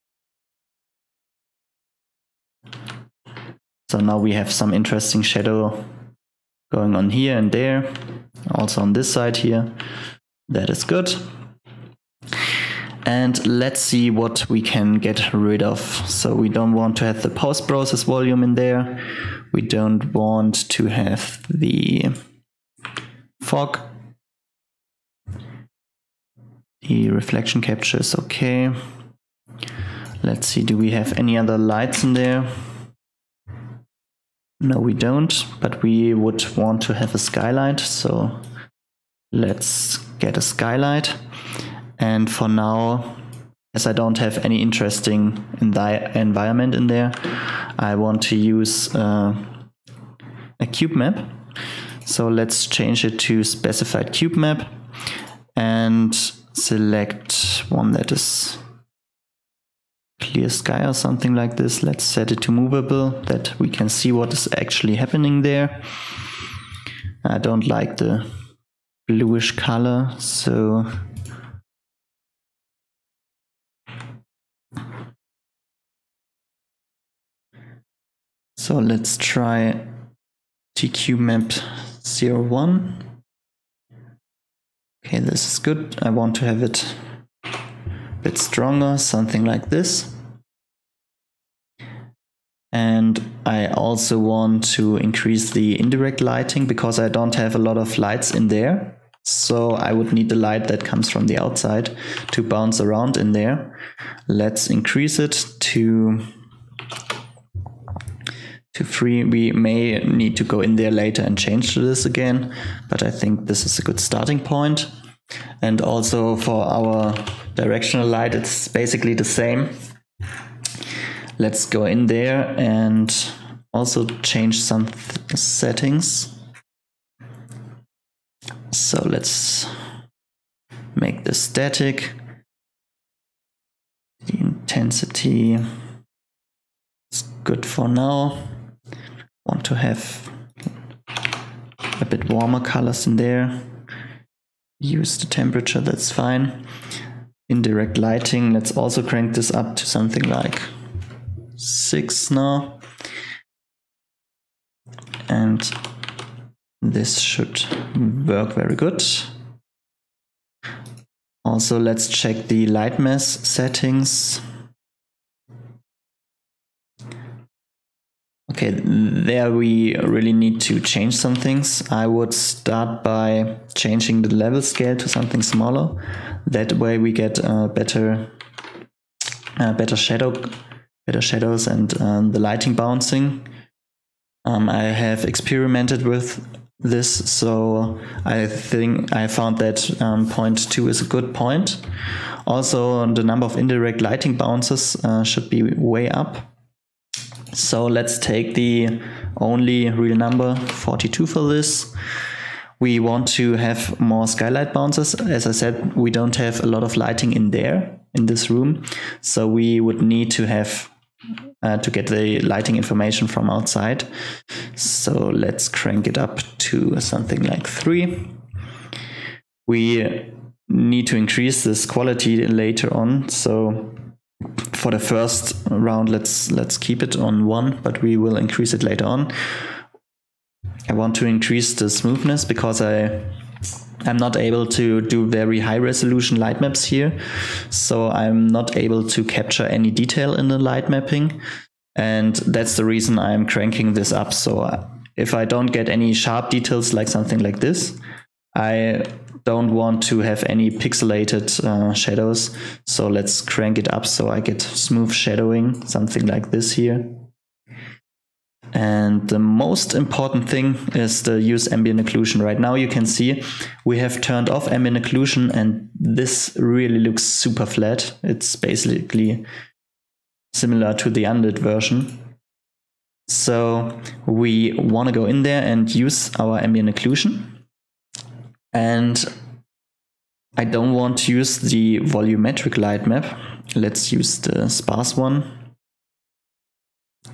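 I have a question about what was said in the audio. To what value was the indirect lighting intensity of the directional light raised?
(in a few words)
6.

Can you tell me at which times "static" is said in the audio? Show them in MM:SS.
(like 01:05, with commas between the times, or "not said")
02:11.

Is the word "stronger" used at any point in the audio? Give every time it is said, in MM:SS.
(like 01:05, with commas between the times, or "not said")
01:28.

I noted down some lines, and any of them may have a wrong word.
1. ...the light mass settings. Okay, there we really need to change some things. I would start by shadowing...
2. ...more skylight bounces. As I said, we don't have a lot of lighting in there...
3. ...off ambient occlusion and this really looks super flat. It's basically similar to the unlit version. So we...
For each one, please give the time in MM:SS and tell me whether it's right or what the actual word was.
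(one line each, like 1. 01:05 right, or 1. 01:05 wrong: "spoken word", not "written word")
1. 02:42 wrong: "changing", not "shadowing"
2. 03:24 right
3. 04:24 right.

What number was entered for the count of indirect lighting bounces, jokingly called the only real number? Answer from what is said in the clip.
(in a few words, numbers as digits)
42.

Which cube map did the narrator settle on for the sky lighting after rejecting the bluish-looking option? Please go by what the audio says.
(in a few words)
TQ map 01.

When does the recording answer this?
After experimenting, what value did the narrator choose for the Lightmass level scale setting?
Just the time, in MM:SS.
03:10.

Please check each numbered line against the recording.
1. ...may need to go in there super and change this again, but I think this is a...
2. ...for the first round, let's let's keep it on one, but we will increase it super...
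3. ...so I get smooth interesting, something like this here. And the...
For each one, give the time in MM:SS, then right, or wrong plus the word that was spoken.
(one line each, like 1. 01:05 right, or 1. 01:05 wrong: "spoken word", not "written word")
1. 01:49 wrong: "later", not "super"
2. 03:44 wrong: "later", not "super"
3. 04:14 wrong: "shadowing", not "interesting".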